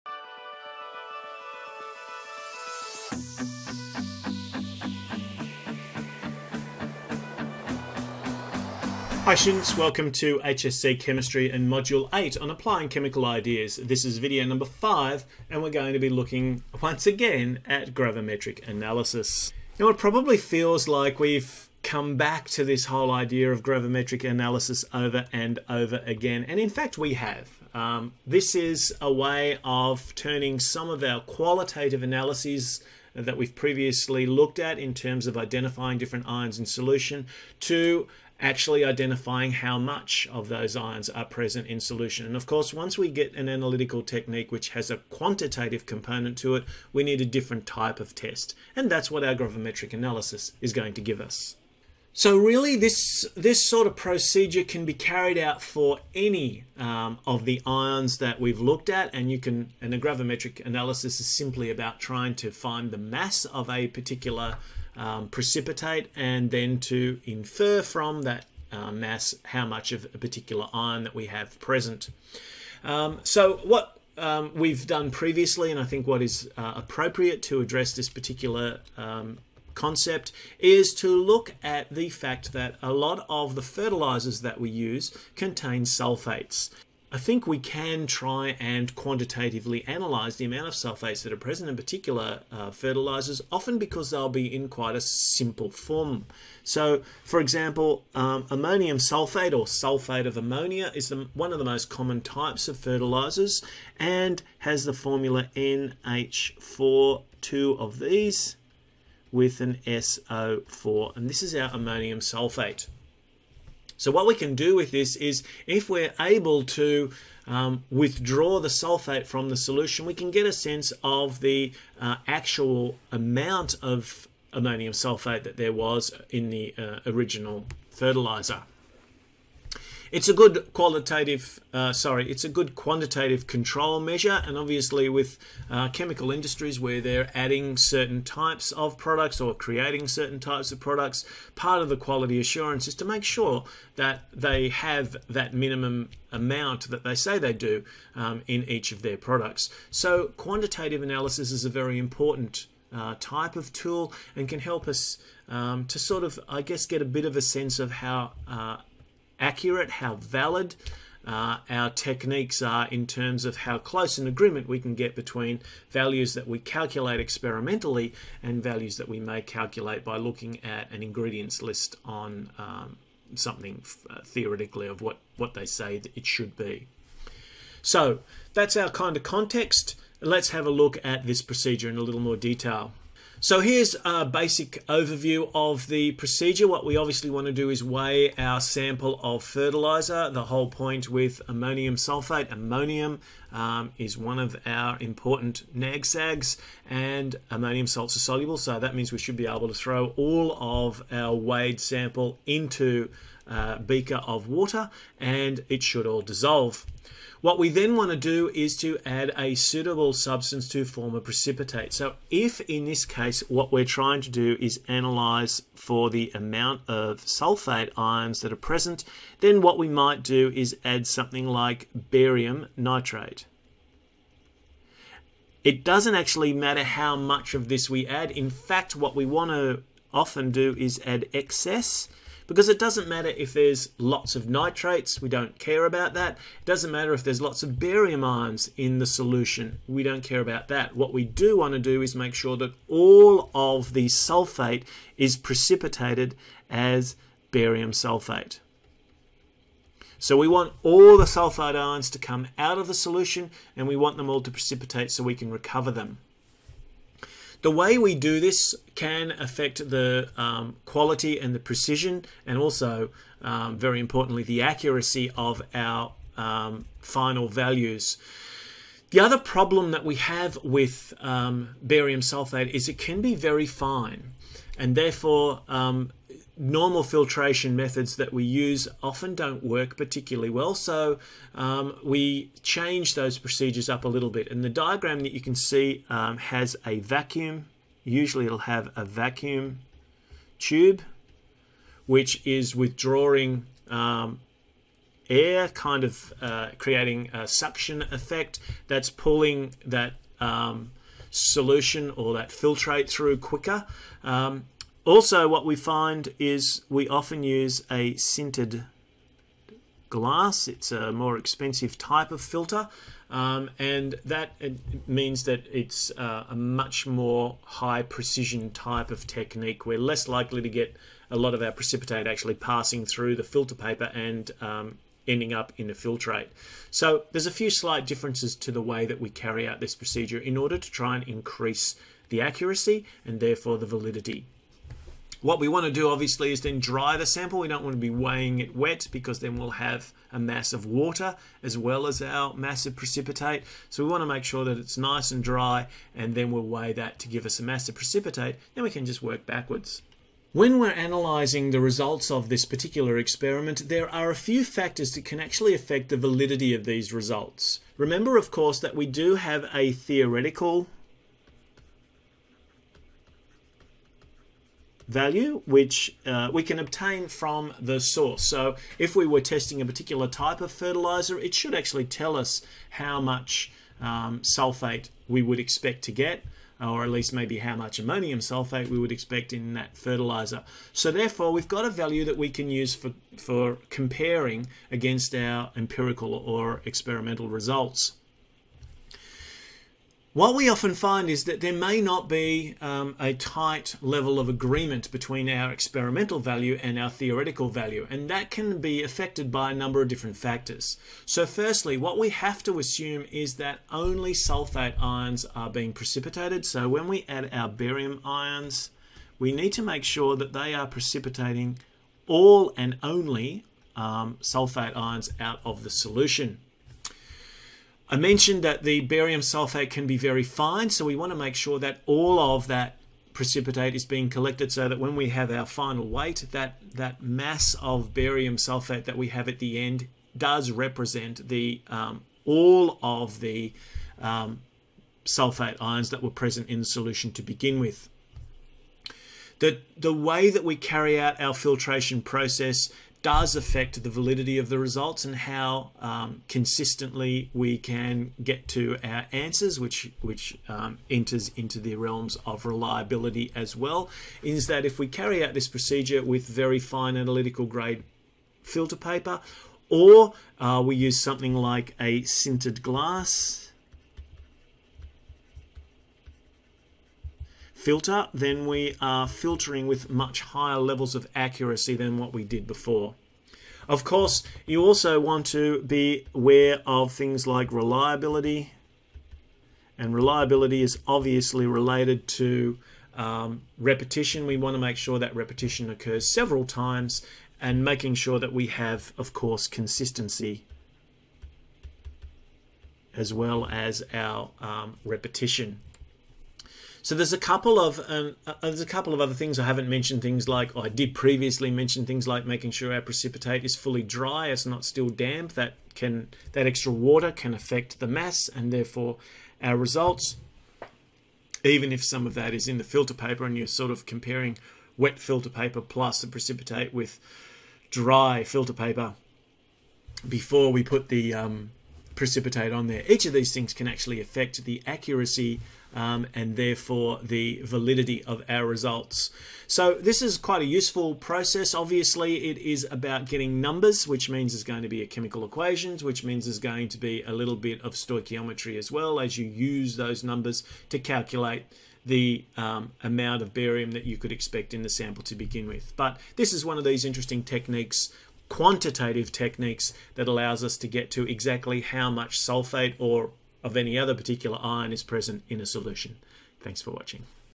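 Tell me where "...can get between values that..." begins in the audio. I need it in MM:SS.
02:44.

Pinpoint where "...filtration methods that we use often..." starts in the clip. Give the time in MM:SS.
04:37.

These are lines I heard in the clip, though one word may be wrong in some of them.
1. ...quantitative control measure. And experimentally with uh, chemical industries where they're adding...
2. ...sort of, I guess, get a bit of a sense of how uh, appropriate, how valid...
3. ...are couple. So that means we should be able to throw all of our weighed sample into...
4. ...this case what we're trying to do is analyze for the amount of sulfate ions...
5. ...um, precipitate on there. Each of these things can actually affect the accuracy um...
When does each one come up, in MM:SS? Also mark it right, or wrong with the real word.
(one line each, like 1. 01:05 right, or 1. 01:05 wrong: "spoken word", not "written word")
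1. 02:12 wrong: "obviously", not "experimentally"
2. 02:35 wrong: "accurate", not "appropriate"
3. 03:18 wrong: "soluble", not "couple"
4. 03:32 right
5. 08:41 right.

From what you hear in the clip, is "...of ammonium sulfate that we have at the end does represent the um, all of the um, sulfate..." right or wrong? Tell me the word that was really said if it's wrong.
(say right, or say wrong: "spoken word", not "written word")
wrong: "barium", not "ammonium".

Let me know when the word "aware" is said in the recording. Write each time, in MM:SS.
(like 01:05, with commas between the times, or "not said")
07:56.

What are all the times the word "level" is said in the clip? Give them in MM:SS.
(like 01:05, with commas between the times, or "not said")
06:34, 07:50.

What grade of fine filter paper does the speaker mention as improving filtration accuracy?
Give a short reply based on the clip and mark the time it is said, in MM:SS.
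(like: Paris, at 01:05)
analytical grade, at 07:37.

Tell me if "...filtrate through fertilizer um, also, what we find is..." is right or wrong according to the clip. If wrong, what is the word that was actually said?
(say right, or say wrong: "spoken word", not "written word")
wrong: "quicker", not "fertilizer".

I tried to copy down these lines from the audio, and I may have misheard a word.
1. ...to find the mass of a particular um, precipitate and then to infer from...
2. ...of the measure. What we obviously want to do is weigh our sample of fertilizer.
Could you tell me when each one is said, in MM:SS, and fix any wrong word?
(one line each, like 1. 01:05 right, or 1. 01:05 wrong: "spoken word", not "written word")
1. 01:02 right
2. 03:05 wrong: "procedure", not "measure".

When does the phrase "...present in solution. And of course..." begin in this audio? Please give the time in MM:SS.
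00:41.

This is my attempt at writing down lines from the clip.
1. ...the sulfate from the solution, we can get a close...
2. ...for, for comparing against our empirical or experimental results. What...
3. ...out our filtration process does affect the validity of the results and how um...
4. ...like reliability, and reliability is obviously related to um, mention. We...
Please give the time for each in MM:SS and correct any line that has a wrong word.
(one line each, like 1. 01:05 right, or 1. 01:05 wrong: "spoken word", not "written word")
1. 01:58 wrong: "sense", not "close"
2. 06:22 right
3. 07:21 right
4. 07:57 wrong: "repetition", not "mention".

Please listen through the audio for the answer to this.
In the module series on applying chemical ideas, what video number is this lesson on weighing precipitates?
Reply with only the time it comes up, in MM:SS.
00:14.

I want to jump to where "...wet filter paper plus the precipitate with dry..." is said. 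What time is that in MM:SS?
08:34.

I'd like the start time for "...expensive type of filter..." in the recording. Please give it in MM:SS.
05:11.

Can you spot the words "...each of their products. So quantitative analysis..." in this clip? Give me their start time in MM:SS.
02:28.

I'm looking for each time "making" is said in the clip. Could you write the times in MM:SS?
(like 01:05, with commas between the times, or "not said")
08:07, 08:22.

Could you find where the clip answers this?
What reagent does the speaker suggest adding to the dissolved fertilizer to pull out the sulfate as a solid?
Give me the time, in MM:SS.
03:42.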